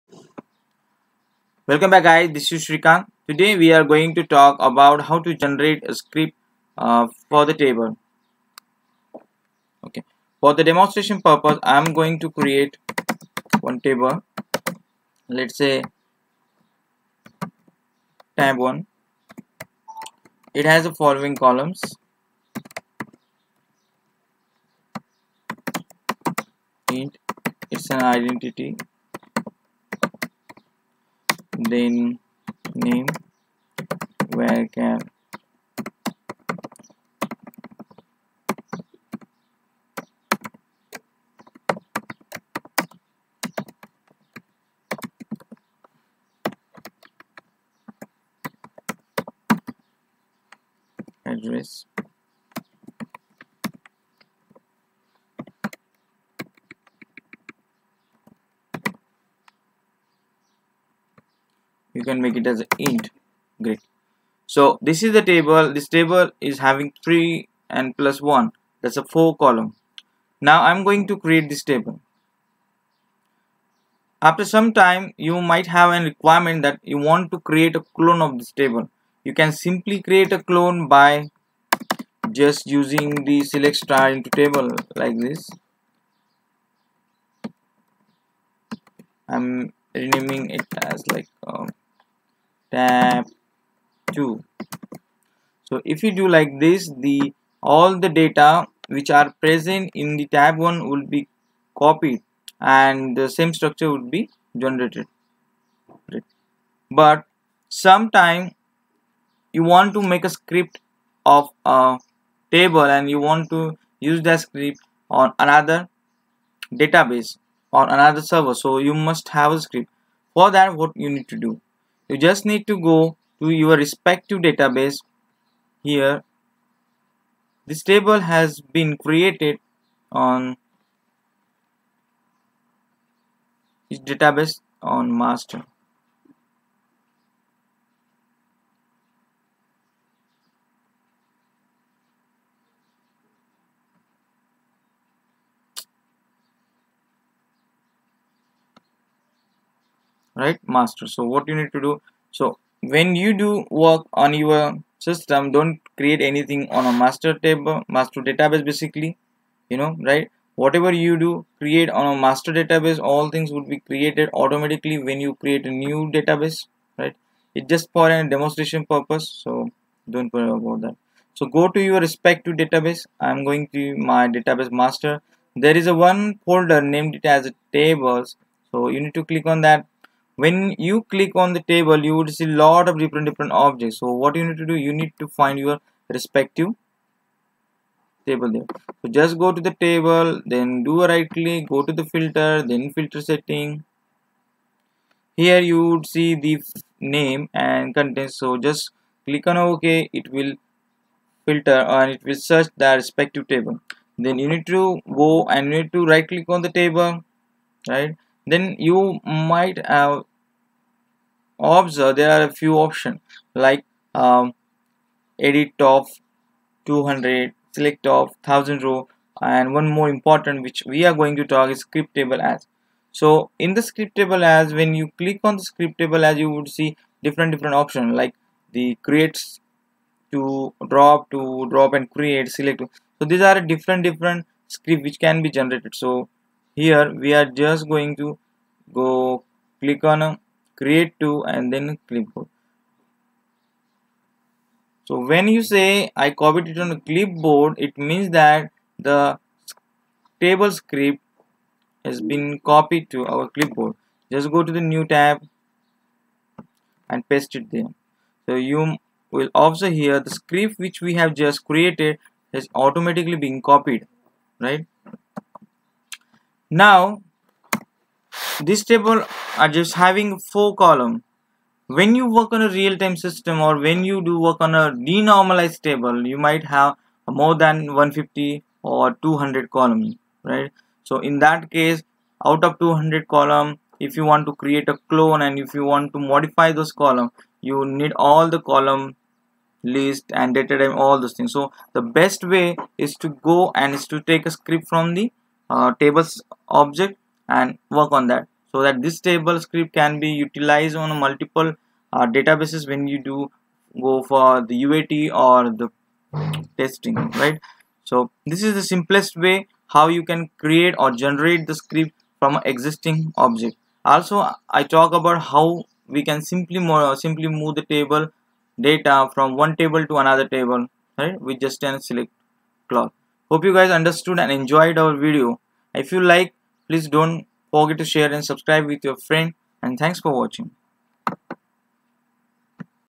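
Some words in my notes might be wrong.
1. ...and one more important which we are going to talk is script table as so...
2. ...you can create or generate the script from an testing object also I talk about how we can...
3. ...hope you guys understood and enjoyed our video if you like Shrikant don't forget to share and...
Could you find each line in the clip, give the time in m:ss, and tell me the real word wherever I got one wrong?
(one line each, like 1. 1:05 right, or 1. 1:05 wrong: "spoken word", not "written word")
1. 3:39 right
2. 5:10 wrong: "existing", not "testing"
3. 5:23 wrong: "Please", not "Shrikant".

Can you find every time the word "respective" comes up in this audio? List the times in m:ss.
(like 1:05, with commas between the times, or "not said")
2:03, 2:51, 3:06, 3:23.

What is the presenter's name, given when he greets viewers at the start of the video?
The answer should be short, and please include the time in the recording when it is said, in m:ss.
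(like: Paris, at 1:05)
Shrikant, at 0:02.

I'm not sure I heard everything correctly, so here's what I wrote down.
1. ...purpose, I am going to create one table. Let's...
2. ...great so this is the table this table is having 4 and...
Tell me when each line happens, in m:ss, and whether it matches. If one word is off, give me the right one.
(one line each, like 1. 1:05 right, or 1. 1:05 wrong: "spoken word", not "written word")
1. 0:11 right
2. 1:03 wrong: "3", not "4".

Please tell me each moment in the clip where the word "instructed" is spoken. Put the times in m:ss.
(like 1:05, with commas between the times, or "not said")
not said.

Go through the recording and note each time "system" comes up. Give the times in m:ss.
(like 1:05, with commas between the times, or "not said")
2:34, 4:33.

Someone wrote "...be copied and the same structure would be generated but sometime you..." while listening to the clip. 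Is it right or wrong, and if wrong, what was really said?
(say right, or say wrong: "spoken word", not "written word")
right.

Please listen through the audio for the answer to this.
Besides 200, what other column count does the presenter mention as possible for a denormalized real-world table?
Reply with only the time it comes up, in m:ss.
4:37.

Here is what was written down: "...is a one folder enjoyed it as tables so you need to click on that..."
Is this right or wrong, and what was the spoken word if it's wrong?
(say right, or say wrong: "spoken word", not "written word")
wrong: "named", not "enjoyed".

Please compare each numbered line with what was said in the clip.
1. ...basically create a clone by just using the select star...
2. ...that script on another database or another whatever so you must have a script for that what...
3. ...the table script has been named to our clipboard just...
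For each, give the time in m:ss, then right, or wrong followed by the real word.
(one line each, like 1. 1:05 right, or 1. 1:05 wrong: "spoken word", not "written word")
1. 1:19 wrong: "simply", not "basically"
2. 1:54 wrong: "server", not "whatever"
3. 4:08 wrong: "copied", not "named".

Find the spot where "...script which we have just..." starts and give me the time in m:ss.
4:20.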